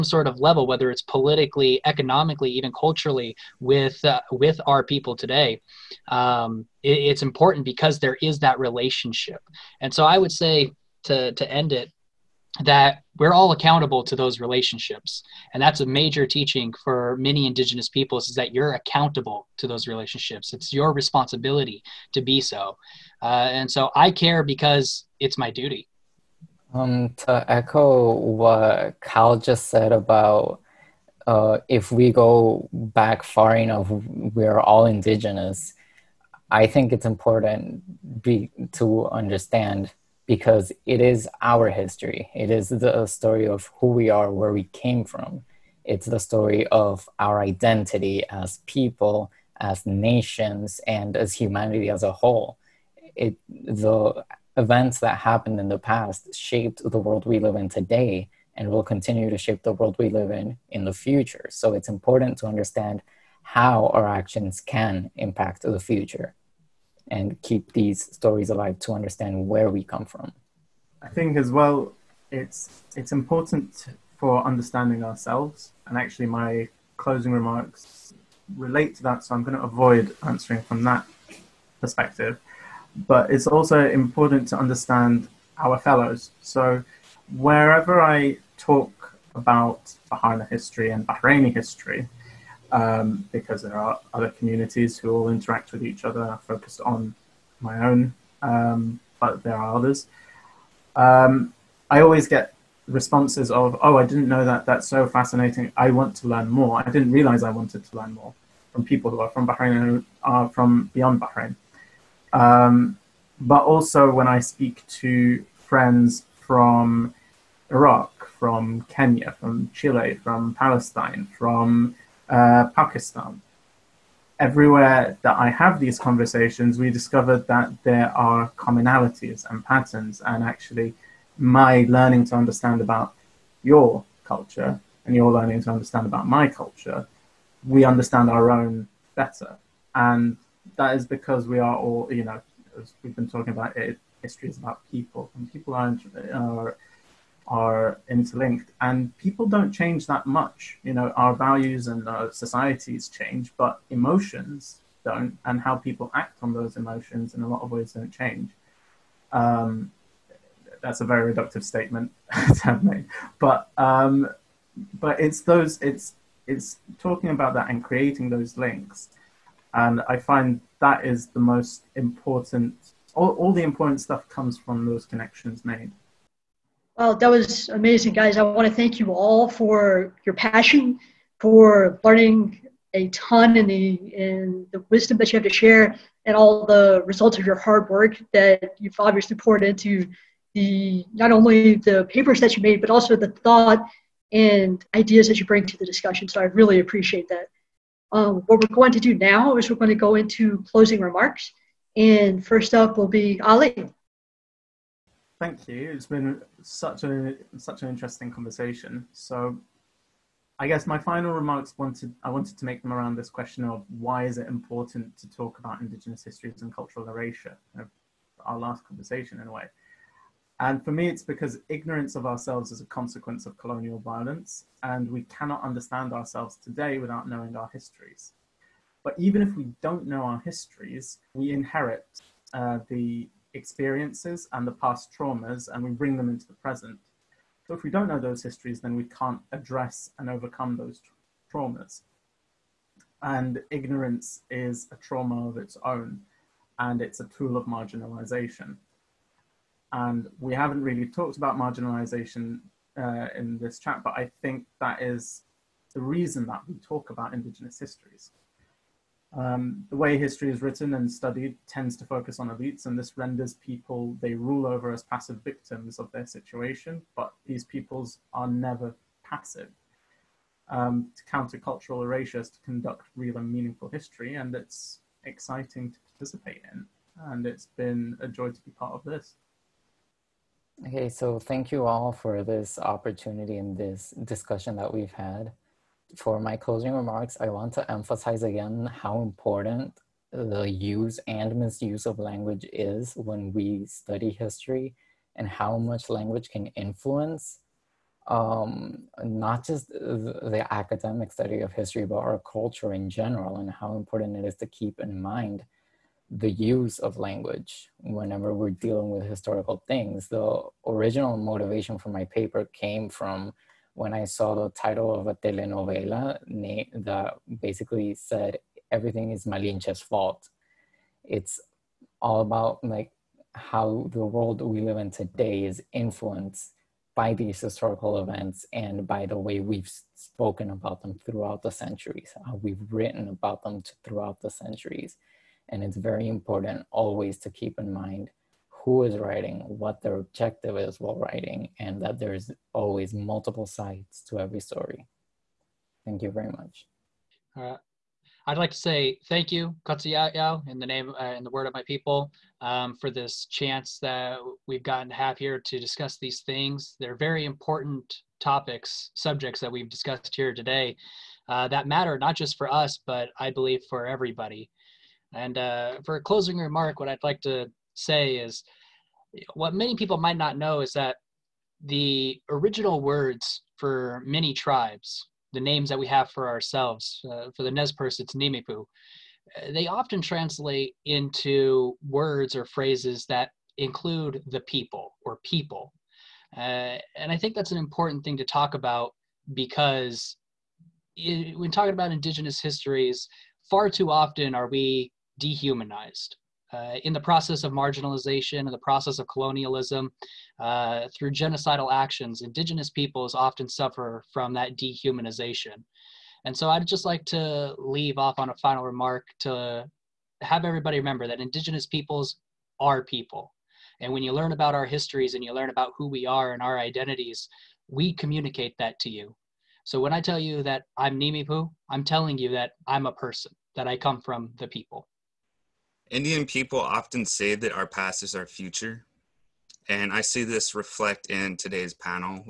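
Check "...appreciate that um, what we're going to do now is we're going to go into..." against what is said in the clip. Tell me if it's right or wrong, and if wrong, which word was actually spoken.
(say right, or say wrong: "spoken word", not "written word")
right.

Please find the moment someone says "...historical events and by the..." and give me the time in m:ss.
5:27.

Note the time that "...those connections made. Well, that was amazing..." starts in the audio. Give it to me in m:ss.
2:54.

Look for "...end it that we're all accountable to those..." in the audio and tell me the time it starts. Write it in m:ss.
0:11.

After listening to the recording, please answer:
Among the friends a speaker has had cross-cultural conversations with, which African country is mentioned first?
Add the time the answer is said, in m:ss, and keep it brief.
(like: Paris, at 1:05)
Kenya, at 1:58.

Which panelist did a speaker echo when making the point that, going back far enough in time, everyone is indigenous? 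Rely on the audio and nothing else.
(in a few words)
Cal.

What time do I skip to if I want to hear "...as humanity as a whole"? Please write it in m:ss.
0:51.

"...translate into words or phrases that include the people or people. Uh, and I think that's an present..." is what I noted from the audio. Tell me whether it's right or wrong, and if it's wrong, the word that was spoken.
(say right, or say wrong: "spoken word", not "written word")
wrong: "important", not "present".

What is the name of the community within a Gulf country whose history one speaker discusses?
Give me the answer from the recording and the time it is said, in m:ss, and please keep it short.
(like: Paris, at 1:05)
Baharna, at 1:30.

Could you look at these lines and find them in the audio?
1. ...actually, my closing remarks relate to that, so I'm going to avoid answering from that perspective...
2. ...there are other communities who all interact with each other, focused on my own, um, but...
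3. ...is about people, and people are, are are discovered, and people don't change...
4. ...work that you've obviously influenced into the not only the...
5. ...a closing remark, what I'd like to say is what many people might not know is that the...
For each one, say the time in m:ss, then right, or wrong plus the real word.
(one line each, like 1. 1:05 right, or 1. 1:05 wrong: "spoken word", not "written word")
1. 1:15 right
2. 1:33 right
3. 2:24 wrong: "interlinked", not "discovered"
4. 3:07 wrong: "poured", not "influenced"
5. 6:06 right.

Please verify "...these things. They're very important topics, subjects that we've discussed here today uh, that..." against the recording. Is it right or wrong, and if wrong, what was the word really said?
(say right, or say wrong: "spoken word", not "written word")
right.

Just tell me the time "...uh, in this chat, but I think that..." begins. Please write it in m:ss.
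4:12.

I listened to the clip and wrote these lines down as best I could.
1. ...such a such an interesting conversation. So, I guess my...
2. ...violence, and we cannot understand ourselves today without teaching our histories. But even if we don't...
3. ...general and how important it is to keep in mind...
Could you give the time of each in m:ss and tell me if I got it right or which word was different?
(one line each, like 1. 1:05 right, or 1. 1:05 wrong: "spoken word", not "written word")
1. 3:26 right
2. 3:43 wrong: "knowing", not "teaching"
3. 5:03 right.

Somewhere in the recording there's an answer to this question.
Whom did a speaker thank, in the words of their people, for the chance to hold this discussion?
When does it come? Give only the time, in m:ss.
5:49.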